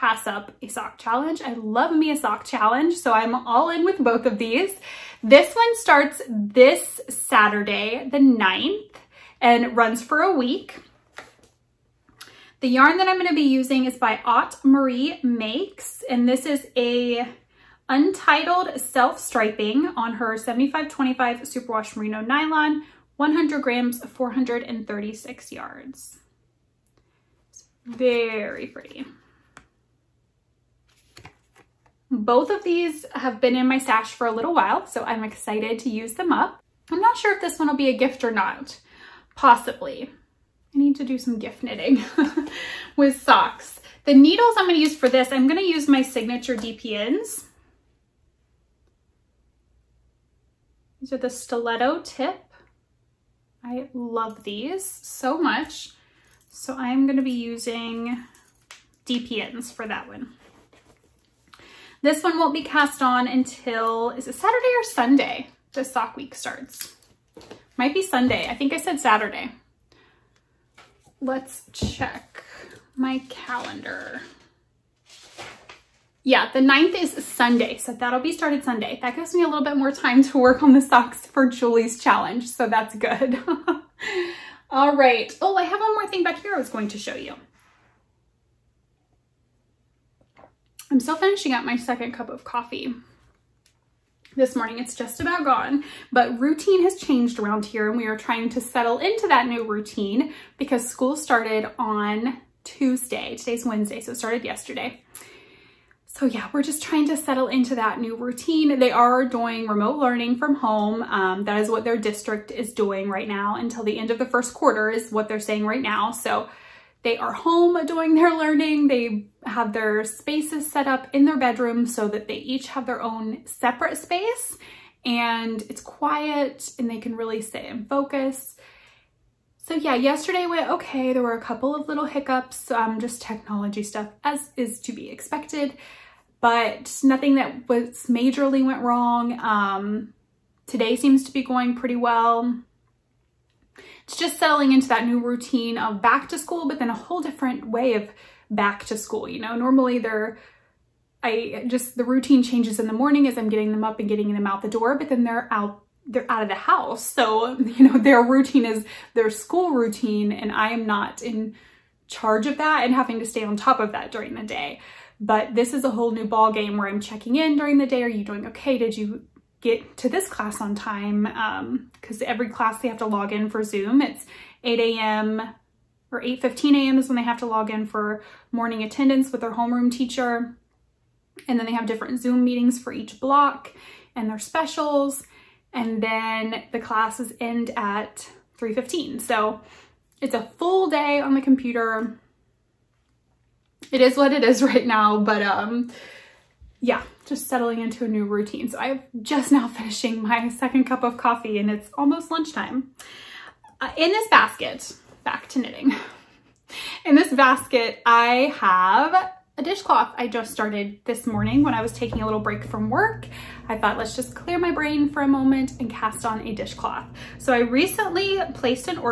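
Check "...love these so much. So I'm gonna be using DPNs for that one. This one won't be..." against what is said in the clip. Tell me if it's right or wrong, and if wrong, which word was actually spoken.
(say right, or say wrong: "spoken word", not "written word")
right.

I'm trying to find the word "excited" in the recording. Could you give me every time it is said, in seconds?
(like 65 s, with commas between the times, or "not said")
35 s.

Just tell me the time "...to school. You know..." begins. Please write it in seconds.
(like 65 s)
148 s.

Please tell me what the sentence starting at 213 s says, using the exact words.
I thought, let's just clear my brain for a moment and cast on a dishcloth.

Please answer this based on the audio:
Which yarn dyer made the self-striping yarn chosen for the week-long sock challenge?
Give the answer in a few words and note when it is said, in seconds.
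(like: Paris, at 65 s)
Aunt Marie Makes, at 14 s.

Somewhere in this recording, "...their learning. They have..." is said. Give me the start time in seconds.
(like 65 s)
118 s.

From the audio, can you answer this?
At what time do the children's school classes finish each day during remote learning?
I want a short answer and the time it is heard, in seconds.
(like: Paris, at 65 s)
3:15, at 188 s.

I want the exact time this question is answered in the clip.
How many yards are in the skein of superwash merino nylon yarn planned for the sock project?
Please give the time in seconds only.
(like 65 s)
24 s.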